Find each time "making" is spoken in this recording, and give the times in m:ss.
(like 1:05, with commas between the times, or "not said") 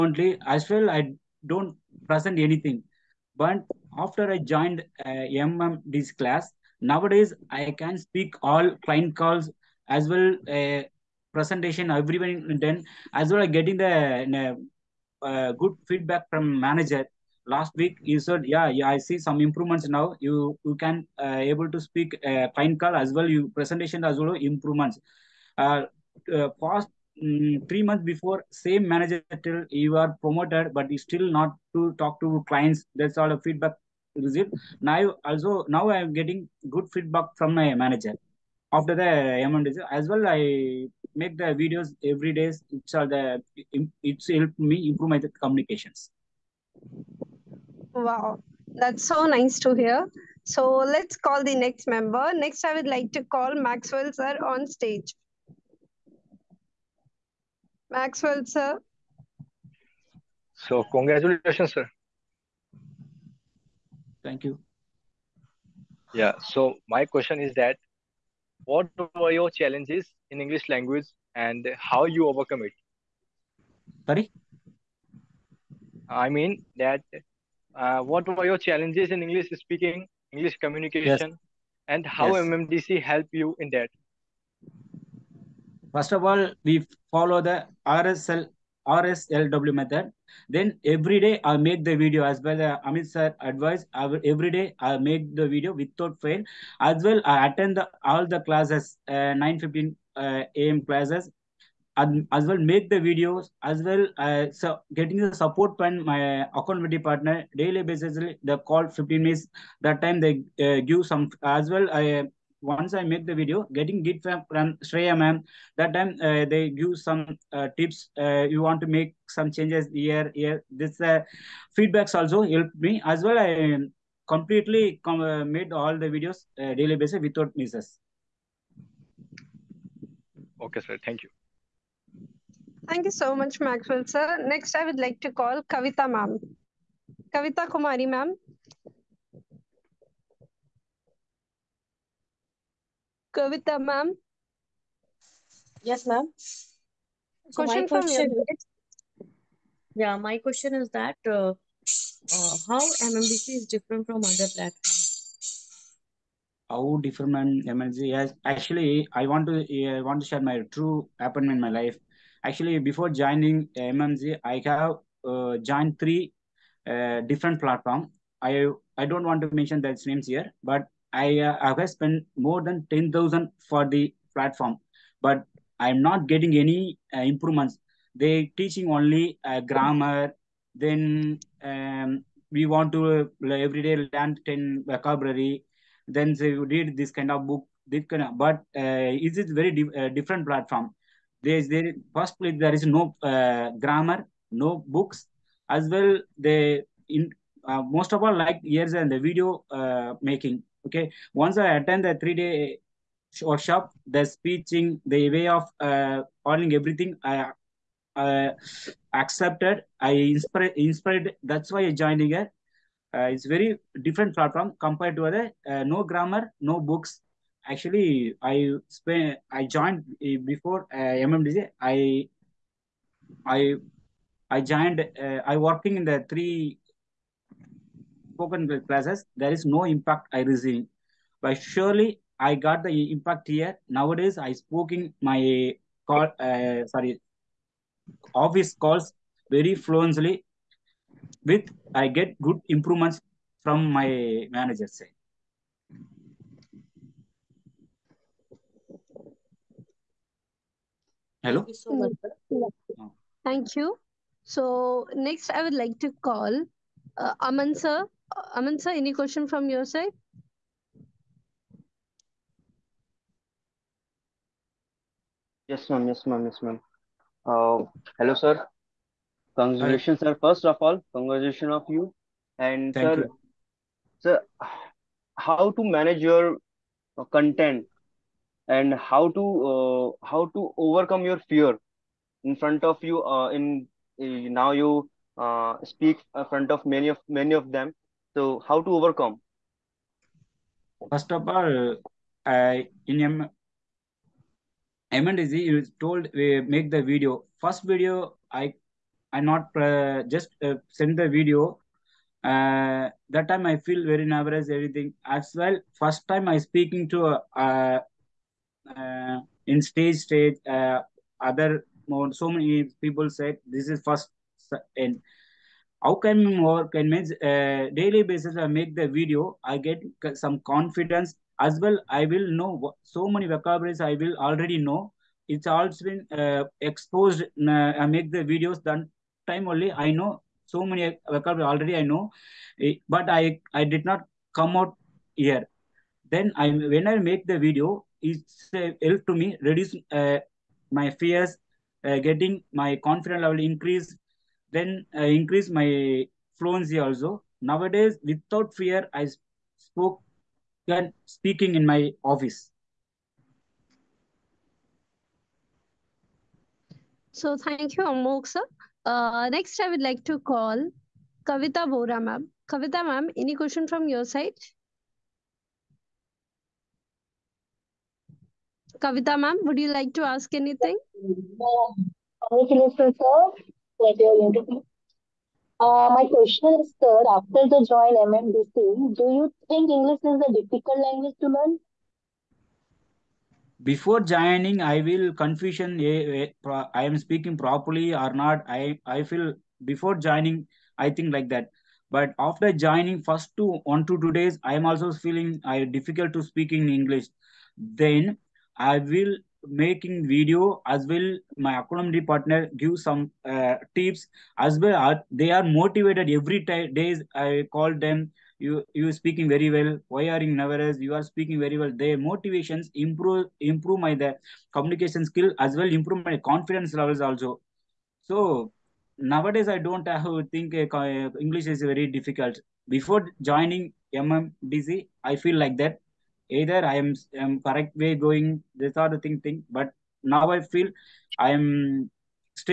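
3:20, 6:39.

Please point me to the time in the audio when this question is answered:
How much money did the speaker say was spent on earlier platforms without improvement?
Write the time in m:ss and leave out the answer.
2:52.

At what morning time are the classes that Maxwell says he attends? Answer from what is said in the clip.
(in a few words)
9:15 a.m.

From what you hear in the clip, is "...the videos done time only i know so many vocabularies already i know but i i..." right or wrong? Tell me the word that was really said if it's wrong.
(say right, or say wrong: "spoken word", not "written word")
right.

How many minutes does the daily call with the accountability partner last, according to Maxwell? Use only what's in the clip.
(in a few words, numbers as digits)
15 minutes.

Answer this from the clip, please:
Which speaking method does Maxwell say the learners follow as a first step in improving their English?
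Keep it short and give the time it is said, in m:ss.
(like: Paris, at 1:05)
RSLW method, at 1:27.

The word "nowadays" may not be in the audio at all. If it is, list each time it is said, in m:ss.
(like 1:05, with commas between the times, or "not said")
0:06, 3:53, 5:47, 6:59.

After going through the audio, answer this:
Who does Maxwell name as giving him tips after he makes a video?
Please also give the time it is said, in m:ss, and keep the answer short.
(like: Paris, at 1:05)
Shreya ma'am, at 1:54.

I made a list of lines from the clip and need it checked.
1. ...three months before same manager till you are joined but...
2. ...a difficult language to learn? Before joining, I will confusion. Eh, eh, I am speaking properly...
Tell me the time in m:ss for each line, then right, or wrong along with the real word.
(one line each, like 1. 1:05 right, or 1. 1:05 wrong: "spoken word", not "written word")
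1. 0:27 wrong: "promoted", not "joined"
2. 6:20 right.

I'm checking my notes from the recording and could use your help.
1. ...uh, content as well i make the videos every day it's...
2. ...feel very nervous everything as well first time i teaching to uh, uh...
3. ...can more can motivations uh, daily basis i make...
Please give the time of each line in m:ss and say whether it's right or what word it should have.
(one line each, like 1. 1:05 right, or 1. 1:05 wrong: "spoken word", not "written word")
1. 0:39 wrong: "amount", not "content"
2. 5:03 wrong: "speaking", not "teaching"
3. 5:16 wrong: "means", not "motivations".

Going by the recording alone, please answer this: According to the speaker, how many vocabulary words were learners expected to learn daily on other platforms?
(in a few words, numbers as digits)
10.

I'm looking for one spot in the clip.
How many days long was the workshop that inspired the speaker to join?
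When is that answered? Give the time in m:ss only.
3:22.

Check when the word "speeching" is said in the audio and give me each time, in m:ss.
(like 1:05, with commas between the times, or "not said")
3:24.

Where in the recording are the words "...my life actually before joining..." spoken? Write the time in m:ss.
2:41.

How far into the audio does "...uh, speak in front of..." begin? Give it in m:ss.
4:45.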